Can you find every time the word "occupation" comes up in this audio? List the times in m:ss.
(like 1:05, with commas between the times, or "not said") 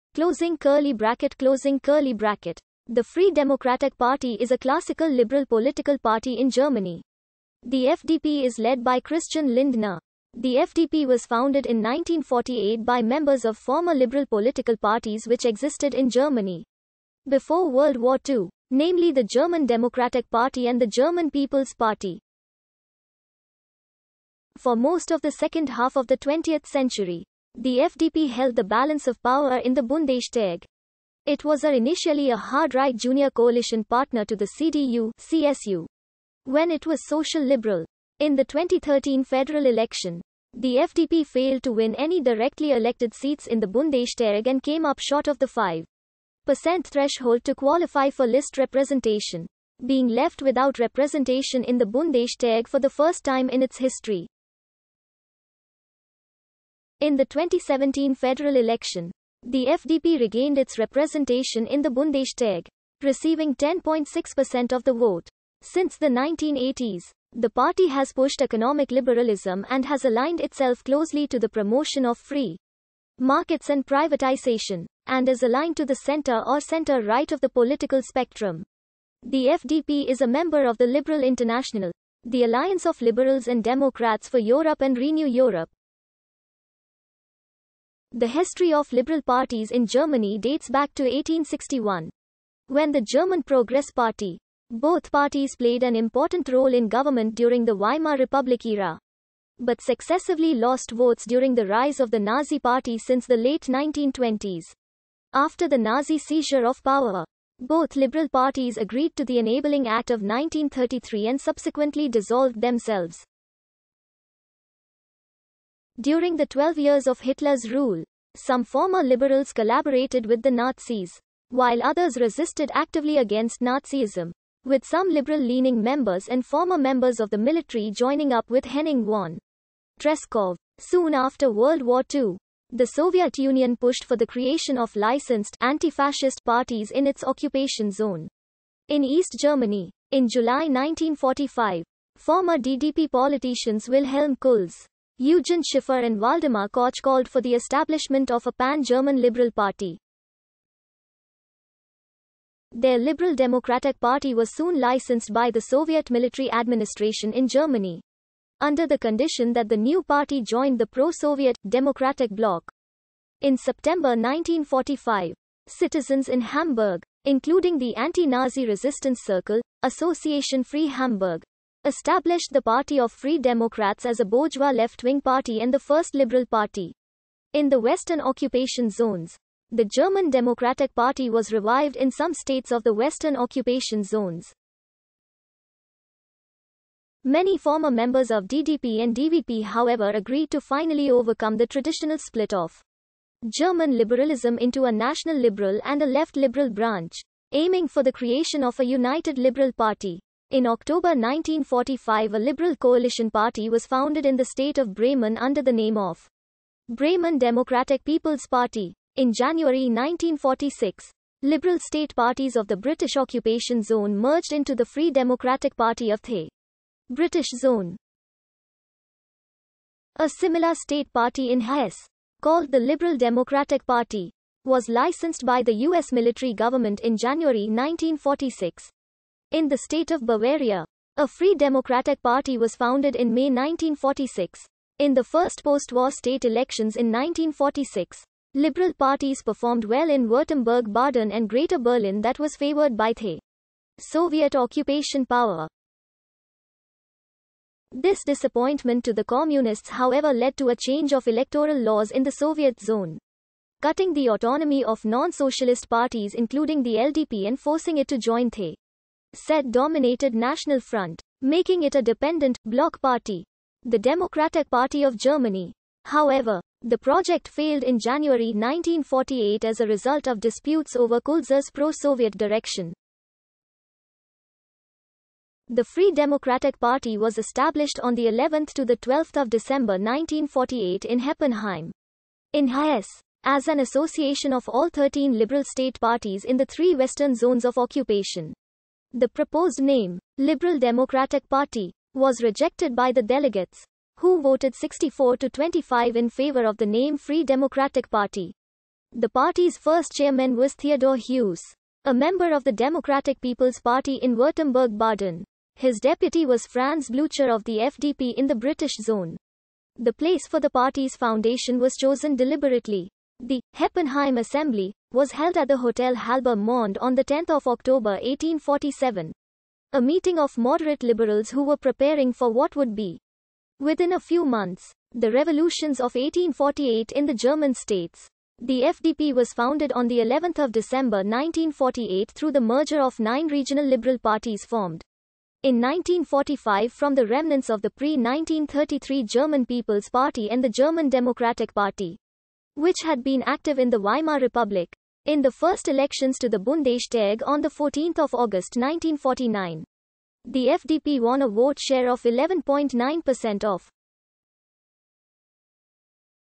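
2:17, 2:58, 3:03, 3:33, 4:04, 4:47.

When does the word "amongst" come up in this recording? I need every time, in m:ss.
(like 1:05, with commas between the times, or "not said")
not said.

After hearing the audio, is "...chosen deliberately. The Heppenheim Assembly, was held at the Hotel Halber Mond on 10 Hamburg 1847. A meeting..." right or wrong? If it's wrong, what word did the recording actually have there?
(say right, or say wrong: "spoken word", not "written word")
wrong: "October", not "Hamburg".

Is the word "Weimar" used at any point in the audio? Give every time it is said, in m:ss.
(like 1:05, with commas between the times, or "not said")
1:37, 5:43.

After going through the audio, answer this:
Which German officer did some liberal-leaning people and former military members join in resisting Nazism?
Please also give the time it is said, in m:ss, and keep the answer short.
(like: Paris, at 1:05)
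Henning von Tresckow, at 2:08.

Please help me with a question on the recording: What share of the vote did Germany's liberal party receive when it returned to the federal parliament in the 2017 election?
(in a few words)
10.6%.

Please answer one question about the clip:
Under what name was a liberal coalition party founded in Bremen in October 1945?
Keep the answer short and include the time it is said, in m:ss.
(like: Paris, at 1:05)
Bremen Democratic People's Party, at 3:26.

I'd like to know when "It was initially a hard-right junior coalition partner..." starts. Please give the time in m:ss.
0:31.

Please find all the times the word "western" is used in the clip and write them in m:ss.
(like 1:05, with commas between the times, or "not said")
2:57, 3:02, 4:46.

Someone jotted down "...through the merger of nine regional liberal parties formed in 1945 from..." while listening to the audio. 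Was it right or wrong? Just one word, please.
right.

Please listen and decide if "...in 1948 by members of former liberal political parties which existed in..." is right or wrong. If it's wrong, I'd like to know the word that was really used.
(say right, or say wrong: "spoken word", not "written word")
right.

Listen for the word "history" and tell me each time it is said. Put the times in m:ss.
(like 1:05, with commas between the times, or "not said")
0:53, 1:28.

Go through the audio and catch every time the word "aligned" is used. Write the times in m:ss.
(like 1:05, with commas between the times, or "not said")
1:10, 1:15.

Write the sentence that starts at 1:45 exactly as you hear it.
After the Nazi seizure of power, both liberal parties agreed to the Enabling Act of 1933 and subsequently dissolved themselves.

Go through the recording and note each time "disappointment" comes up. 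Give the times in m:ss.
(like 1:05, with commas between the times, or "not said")
4:08.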